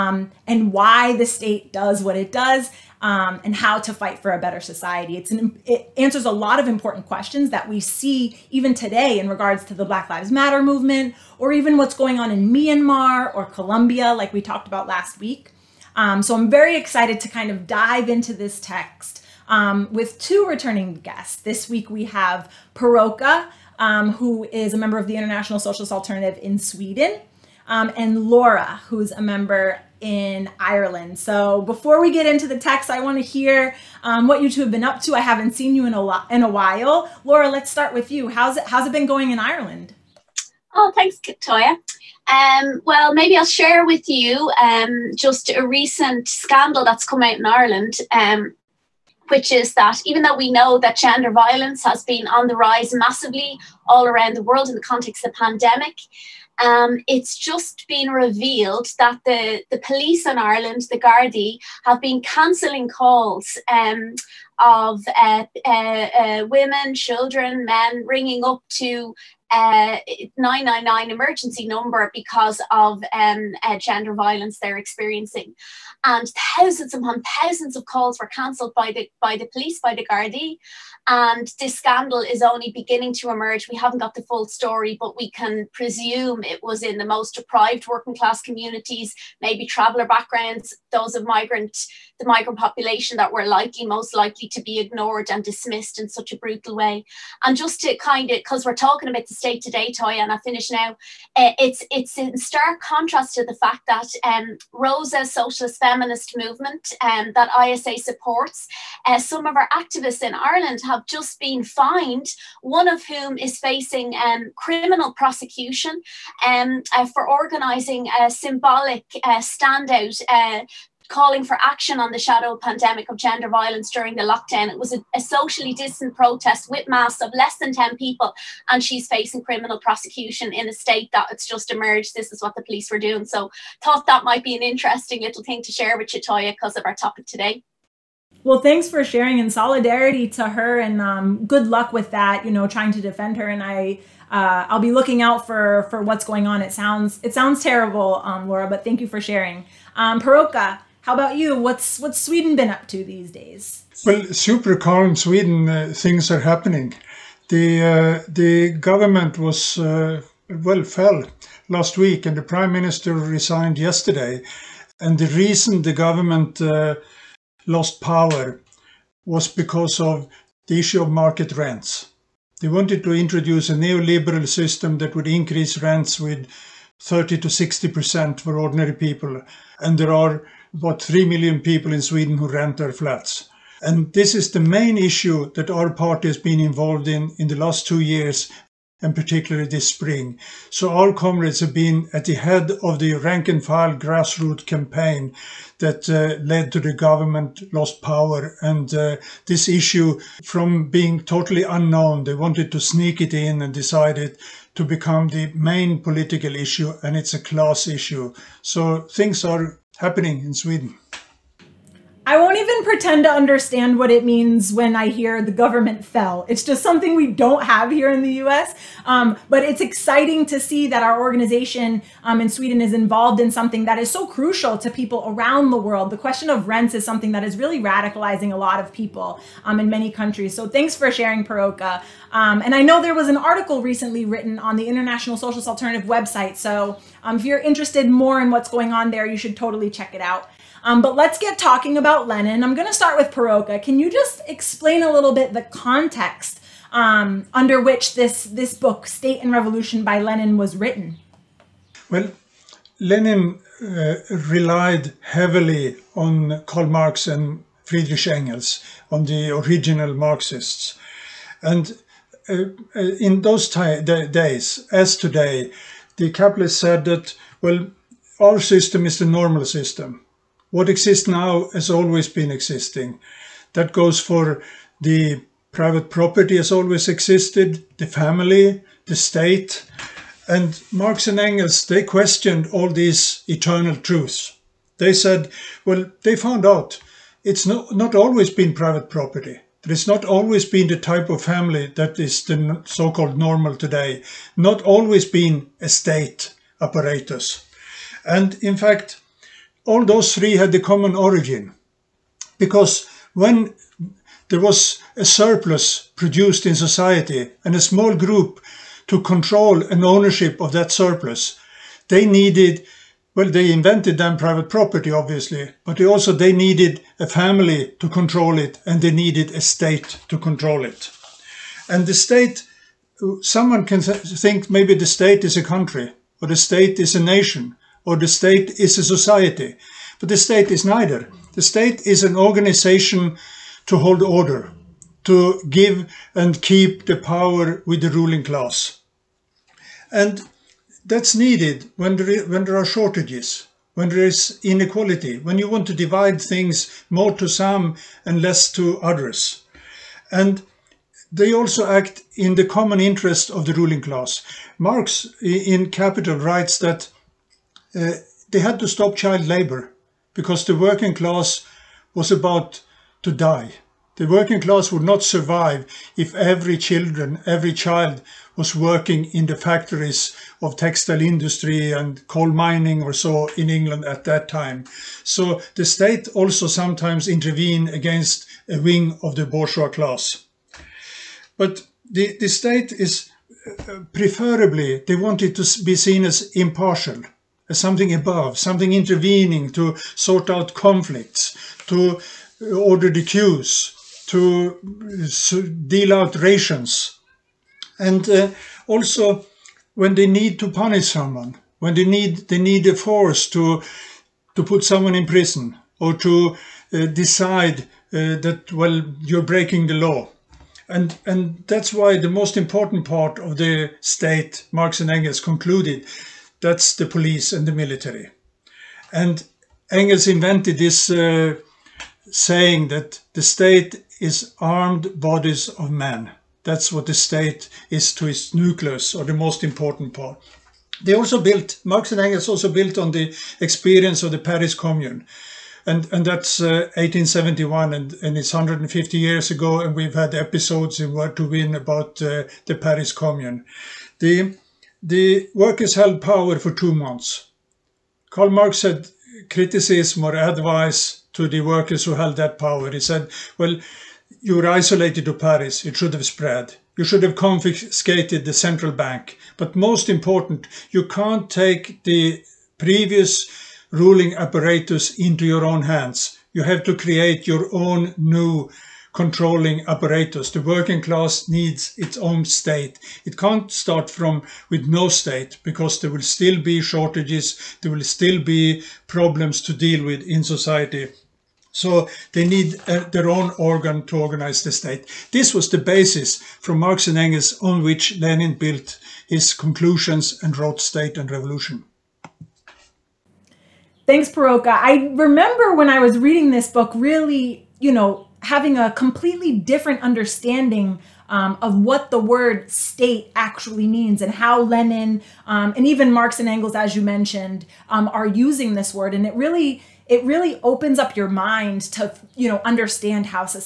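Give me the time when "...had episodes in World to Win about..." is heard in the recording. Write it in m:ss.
7:20.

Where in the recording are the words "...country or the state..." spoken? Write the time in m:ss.
5:25.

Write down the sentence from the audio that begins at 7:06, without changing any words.
That's what the state is to its nucleus, or the most important part.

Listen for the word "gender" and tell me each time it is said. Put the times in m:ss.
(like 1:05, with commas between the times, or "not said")
0:50, 1:13, 2:03.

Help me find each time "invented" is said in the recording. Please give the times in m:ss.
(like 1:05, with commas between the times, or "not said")
5:13, 7:00.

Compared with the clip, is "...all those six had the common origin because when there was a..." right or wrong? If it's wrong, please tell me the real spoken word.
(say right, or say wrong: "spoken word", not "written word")
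wrong: "three", not "six".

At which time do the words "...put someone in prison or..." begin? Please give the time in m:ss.
6:44.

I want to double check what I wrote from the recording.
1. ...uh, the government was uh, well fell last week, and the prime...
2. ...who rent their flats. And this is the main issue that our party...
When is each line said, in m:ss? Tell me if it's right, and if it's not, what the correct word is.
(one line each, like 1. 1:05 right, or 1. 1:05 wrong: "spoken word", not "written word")
1. 2:37 right
2. 3:02 right.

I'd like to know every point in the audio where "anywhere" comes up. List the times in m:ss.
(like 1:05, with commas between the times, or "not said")
not said.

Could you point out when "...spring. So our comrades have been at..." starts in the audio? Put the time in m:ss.
3:09.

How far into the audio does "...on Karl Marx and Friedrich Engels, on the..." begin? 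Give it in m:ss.
4:16.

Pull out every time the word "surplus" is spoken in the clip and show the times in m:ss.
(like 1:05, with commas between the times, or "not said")
5:05, 5:10.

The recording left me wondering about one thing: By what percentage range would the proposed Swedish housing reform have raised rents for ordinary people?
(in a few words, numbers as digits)
30 to 60 percent.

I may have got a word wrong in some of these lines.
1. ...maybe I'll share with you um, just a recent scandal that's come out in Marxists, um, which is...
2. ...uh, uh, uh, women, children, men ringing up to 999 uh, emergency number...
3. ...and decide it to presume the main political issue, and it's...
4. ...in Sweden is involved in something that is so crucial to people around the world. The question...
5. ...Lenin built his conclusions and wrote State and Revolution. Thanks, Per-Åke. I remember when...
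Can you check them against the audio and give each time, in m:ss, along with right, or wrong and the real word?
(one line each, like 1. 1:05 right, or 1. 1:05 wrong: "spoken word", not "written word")
1. 0:43 wrong: "Ireland", not "Marxists"
2. 1:05 right
3. 3:23 wrong: "become", not "presume"
4. 3:42 right
5. 8:08 right.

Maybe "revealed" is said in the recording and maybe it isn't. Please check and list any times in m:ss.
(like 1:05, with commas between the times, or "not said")
0:58.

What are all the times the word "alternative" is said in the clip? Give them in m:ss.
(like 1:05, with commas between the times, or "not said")
0:25, 3:55.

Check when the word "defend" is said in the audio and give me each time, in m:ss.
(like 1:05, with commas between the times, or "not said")
2:23.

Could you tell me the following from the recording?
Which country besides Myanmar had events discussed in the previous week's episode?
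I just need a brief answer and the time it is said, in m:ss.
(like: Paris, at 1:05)
Colombia, at 0:13.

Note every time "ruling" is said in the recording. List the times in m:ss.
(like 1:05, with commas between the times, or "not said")
5:38, 5:53, 7:43.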